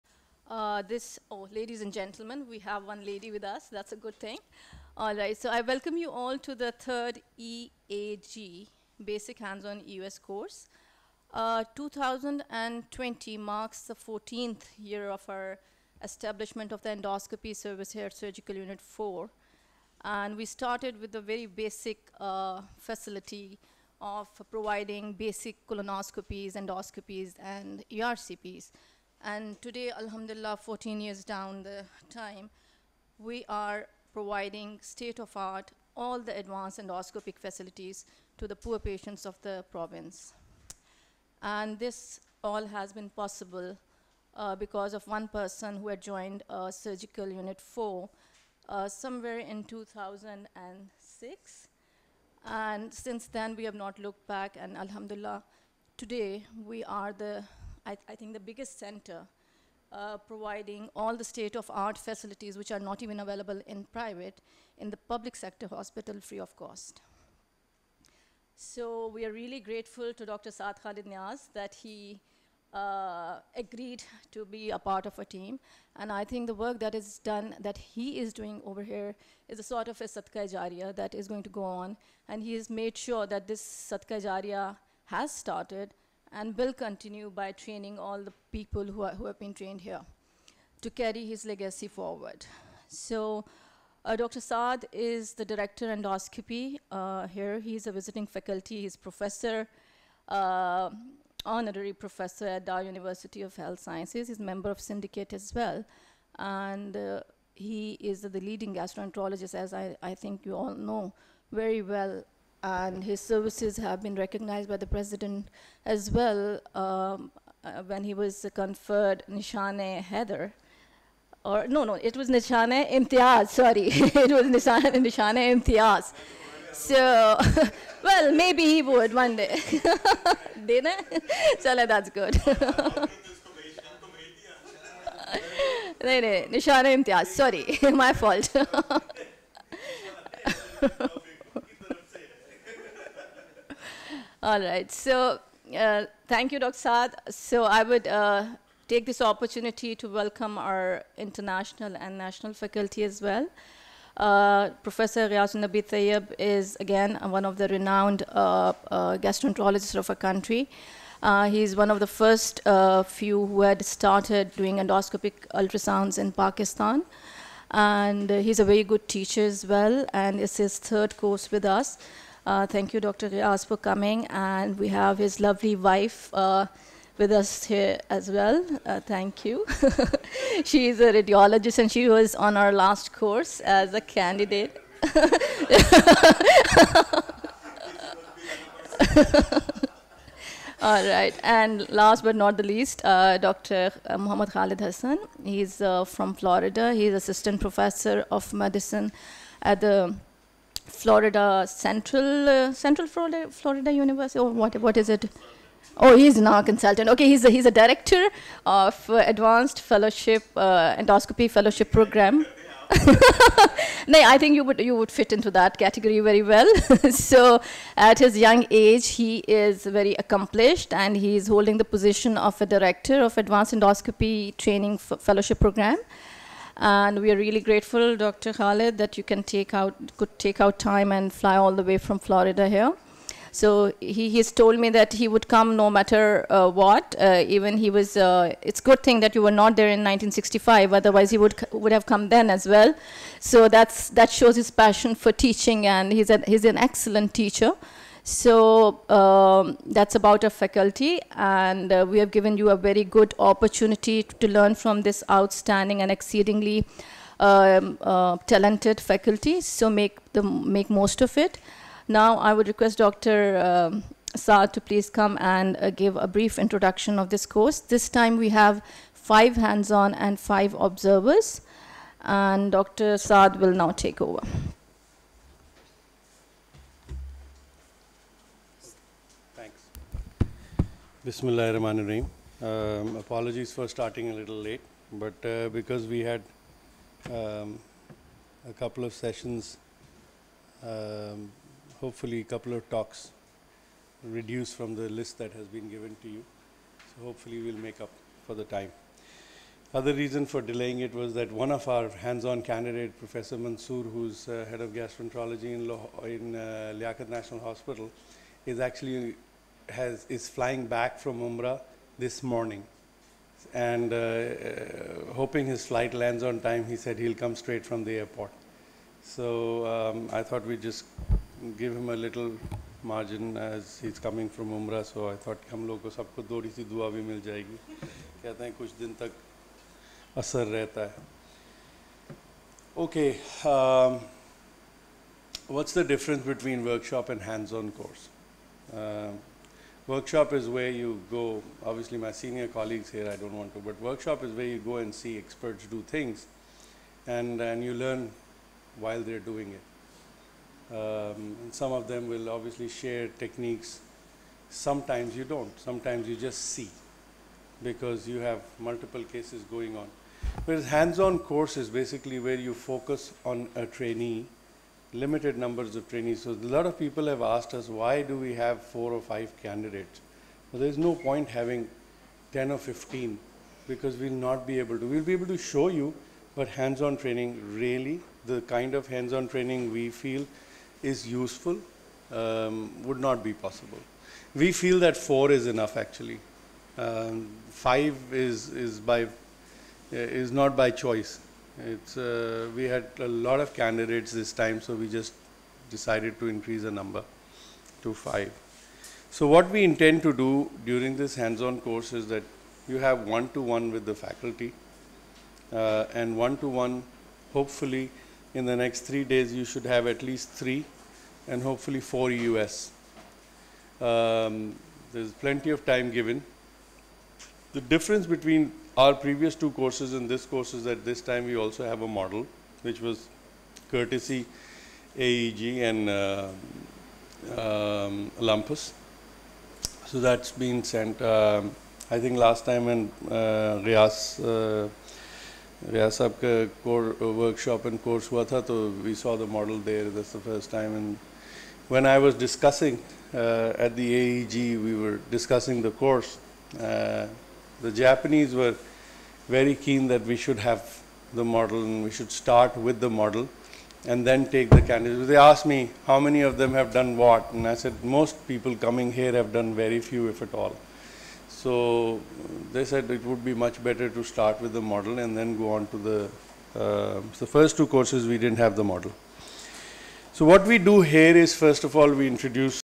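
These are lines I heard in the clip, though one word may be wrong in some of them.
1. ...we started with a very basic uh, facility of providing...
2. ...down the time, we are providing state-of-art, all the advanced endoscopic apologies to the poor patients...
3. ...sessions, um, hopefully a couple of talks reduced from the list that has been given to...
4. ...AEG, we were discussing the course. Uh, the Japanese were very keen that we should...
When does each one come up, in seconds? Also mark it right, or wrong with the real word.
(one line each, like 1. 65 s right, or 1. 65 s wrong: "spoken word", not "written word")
1. 20 s right
2. 31 s wrong: "facilities", not "apologies"
3. 289 s right
4. 444 s right.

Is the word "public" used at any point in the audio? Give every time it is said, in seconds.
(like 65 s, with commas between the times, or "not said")
64 s.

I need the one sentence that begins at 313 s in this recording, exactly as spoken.
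And uh, uh, hoping his flight lands on time, he said he'll come straight from the airport.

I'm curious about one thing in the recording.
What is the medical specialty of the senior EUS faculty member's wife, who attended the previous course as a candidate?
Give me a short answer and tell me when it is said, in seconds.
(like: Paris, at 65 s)
Radiologist, at 181 s.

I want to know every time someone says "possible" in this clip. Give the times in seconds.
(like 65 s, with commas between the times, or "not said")
43 s, 383 s.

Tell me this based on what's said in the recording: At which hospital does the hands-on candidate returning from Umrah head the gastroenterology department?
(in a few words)
Liaquat National Hospital.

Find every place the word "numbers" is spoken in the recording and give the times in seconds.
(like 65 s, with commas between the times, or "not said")
365 s, 396 s.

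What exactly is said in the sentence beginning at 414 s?
Um, there's plenty of time given.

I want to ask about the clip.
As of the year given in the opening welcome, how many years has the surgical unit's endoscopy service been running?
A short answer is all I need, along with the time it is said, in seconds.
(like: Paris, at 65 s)
14, at 13 s.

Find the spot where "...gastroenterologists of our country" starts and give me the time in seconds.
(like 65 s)
159 s.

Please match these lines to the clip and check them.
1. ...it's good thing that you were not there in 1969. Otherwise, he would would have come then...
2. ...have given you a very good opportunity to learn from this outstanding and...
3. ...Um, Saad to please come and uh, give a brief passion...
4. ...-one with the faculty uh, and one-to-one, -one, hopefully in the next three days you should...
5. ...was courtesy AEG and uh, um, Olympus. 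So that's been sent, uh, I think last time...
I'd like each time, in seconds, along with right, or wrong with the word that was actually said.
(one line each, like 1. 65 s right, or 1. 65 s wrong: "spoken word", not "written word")
1. 238 s wrong: "1965", not "1969"
2. 252 s right
3. 263 s wrong: "introduction", not "passion"
4. 403 s right
5. 422 s right.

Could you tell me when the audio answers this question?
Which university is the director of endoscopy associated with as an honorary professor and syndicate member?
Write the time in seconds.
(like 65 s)
102 s.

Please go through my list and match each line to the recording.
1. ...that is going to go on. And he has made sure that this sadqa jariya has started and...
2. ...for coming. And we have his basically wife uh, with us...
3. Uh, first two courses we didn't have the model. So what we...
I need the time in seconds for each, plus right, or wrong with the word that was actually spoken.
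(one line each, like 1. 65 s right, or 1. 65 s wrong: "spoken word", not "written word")
1. 80 s right
2. 173 s wrong: "lovely", not "basically"
3. 466 s right.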